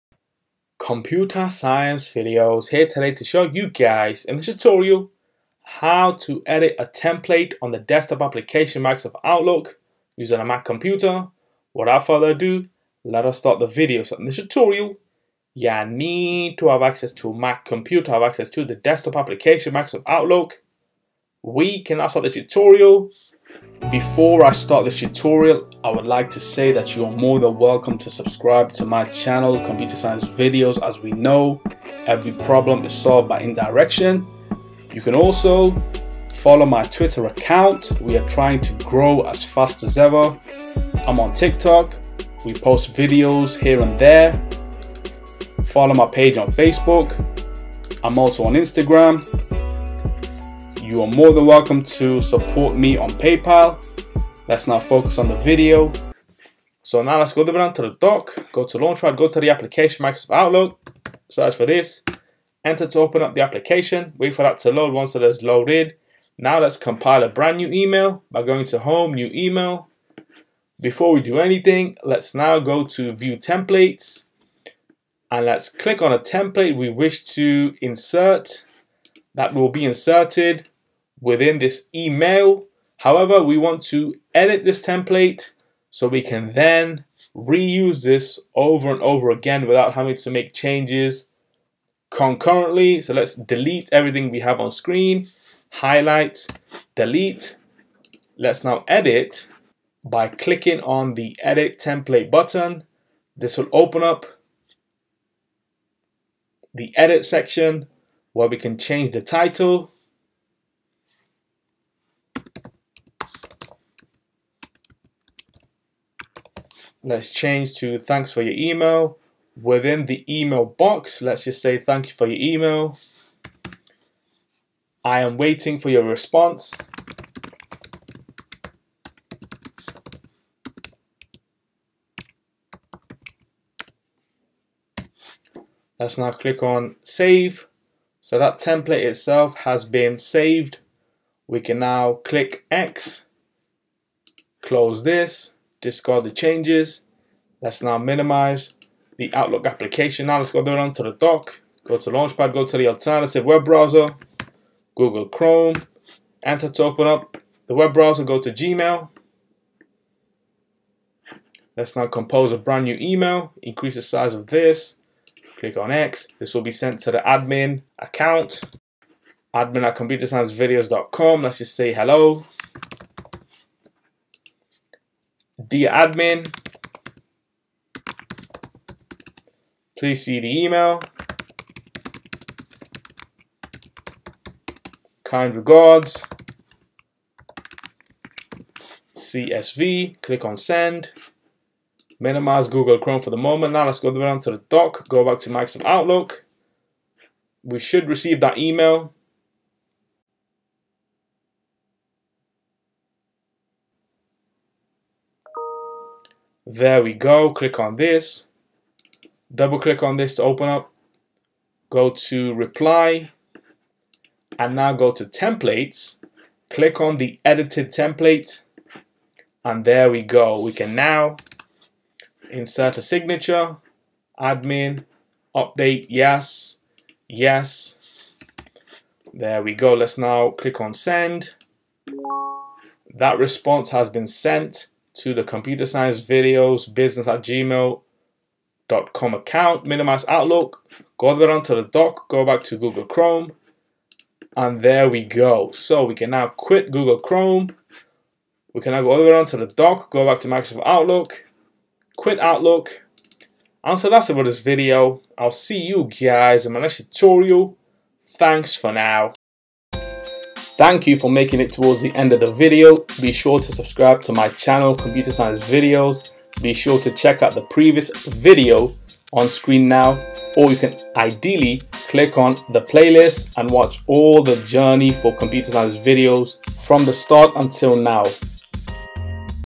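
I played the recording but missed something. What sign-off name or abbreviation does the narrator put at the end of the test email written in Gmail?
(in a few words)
CSV.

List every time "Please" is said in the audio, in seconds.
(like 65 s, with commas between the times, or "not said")
179 s.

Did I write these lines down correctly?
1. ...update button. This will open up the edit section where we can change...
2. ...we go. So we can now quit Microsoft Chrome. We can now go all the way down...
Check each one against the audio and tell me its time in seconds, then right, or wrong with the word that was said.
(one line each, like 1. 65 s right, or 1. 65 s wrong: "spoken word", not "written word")
1. 101 s wrong: "template", not "update"
2. 245 s wrong: "Google", not "Microsoft".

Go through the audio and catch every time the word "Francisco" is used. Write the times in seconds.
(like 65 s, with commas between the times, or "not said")
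not said.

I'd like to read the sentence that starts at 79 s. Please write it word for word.
That will be inserted within this email.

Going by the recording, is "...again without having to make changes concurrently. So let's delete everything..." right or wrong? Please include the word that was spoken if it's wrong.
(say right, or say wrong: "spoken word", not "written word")
right.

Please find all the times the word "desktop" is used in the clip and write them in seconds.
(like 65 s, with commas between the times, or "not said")
7 s, 18 s.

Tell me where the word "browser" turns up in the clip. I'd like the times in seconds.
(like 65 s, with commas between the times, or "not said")
153 s, 157 s.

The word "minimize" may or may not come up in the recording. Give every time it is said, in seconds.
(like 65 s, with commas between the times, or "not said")
147 s, 192 s, 239 s.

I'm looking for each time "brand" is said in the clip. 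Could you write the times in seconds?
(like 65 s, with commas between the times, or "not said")
67 s, 162 s.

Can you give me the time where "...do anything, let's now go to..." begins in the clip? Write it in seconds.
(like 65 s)
71 s.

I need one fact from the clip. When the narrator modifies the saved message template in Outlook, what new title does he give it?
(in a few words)
Thanks for your email.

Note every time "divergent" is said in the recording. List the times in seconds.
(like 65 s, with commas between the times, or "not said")
not said.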